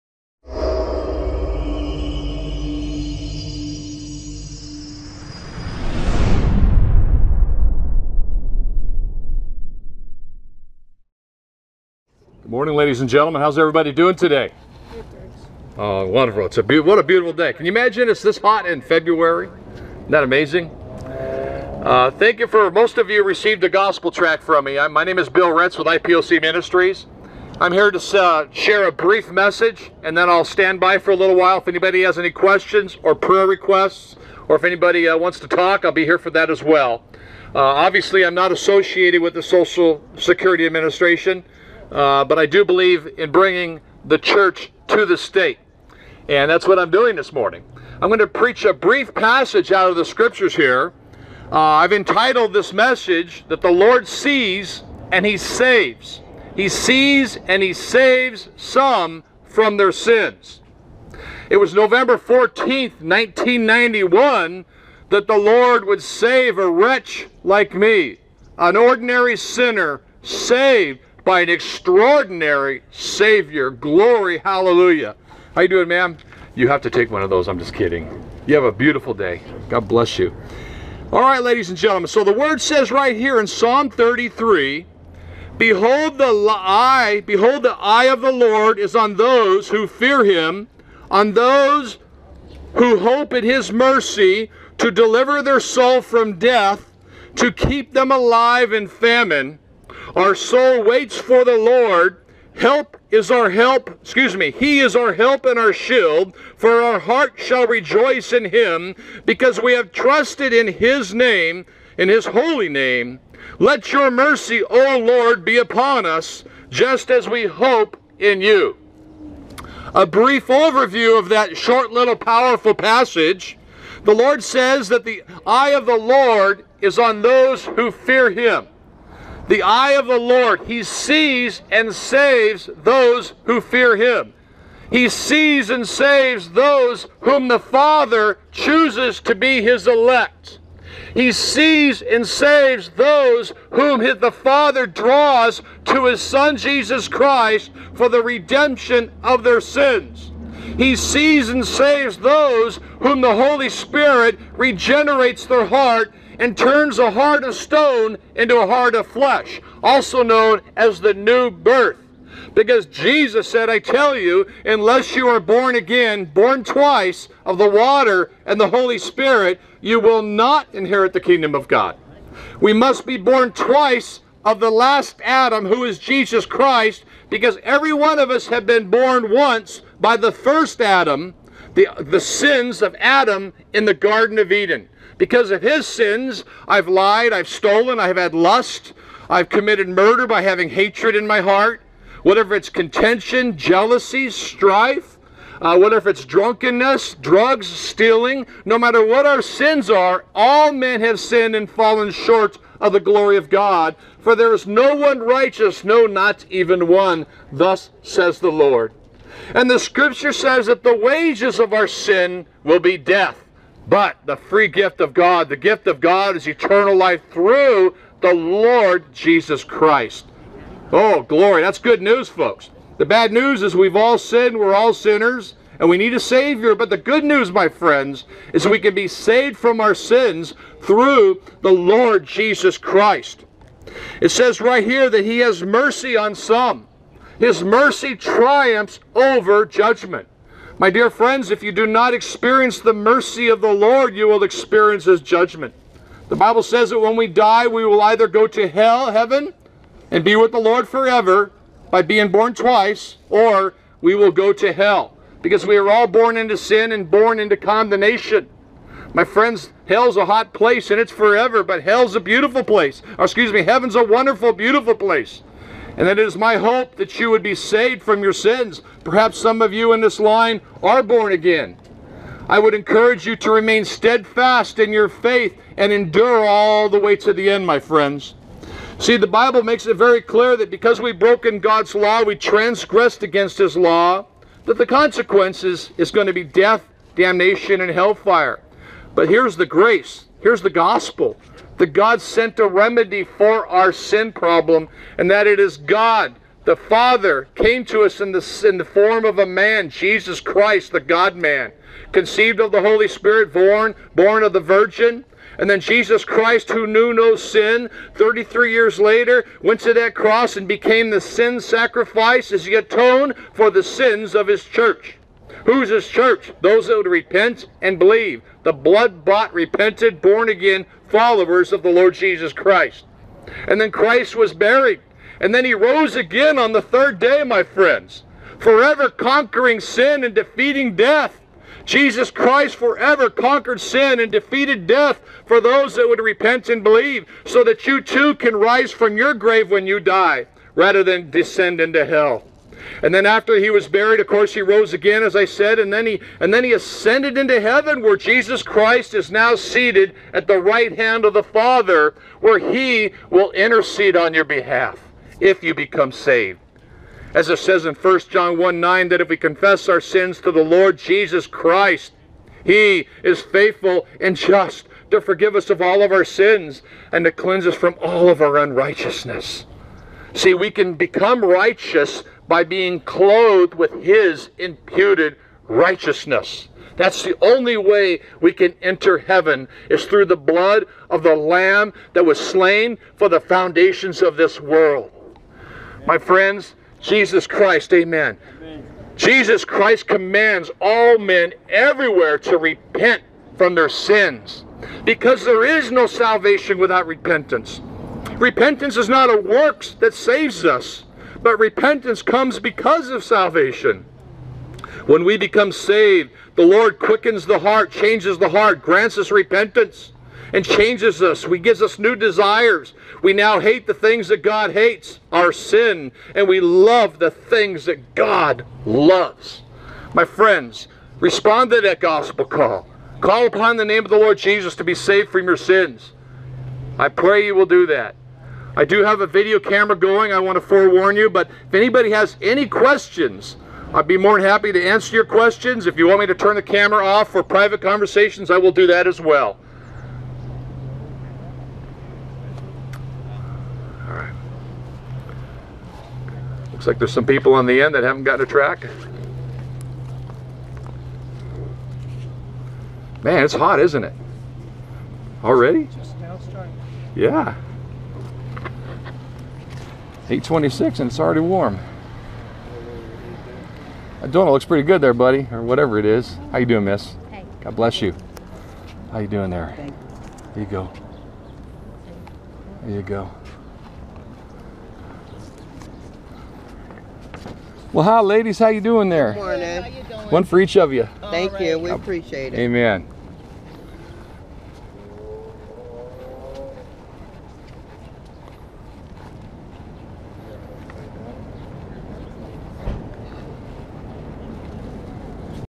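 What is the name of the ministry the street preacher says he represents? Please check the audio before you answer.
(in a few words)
IPOC Ministries.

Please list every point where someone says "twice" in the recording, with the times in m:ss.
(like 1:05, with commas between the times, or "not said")
2:46, 2:53, 4:12.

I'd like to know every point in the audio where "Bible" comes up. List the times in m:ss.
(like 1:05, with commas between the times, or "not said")
4:06, 4:39.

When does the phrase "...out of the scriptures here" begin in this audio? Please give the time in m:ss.
0:49.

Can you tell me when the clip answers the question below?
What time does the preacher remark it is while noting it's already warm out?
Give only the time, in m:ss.
7:40.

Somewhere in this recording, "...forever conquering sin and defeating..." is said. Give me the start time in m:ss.
5:28.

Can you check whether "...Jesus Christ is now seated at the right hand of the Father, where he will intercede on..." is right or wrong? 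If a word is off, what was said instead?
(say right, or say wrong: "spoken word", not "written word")
right.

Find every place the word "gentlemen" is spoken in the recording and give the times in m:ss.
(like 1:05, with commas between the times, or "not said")
0:13, 1:21.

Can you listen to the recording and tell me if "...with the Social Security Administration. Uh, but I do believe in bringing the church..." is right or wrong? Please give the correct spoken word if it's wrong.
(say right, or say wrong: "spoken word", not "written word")
right.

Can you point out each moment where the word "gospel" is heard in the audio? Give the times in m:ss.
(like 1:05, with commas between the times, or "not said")
0:23, 4:50, 7:01.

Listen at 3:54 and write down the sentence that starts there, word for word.
It says right here that He has mercy on some his mercy triumphs over judgment.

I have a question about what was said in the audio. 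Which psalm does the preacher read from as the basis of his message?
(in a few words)
Psalm 33.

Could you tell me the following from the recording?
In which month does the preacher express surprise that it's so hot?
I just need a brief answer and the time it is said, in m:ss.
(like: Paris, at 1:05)
February, at 0:18.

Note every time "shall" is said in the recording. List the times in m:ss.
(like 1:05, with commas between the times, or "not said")
1:47.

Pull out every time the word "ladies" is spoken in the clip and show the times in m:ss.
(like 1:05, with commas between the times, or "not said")
0:12, 1:21, 7:58.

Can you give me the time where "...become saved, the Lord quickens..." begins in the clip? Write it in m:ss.
6:45.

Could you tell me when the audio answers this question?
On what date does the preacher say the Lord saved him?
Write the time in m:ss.
1:01.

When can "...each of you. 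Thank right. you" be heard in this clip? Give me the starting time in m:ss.
8:00.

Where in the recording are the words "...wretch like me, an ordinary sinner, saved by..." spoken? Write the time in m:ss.
1:06.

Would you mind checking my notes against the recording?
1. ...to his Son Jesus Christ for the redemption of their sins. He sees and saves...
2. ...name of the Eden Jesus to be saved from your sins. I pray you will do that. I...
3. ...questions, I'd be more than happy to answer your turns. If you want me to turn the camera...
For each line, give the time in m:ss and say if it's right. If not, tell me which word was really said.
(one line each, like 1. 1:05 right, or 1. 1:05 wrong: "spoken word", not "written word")
1. 2:25 right
2. 7:03 wrong: "Lord", not "Eden"
3. 7:12 wrong: "questions", not "turns".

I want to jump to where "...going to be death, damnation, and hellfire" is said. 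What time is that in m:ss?
4:46.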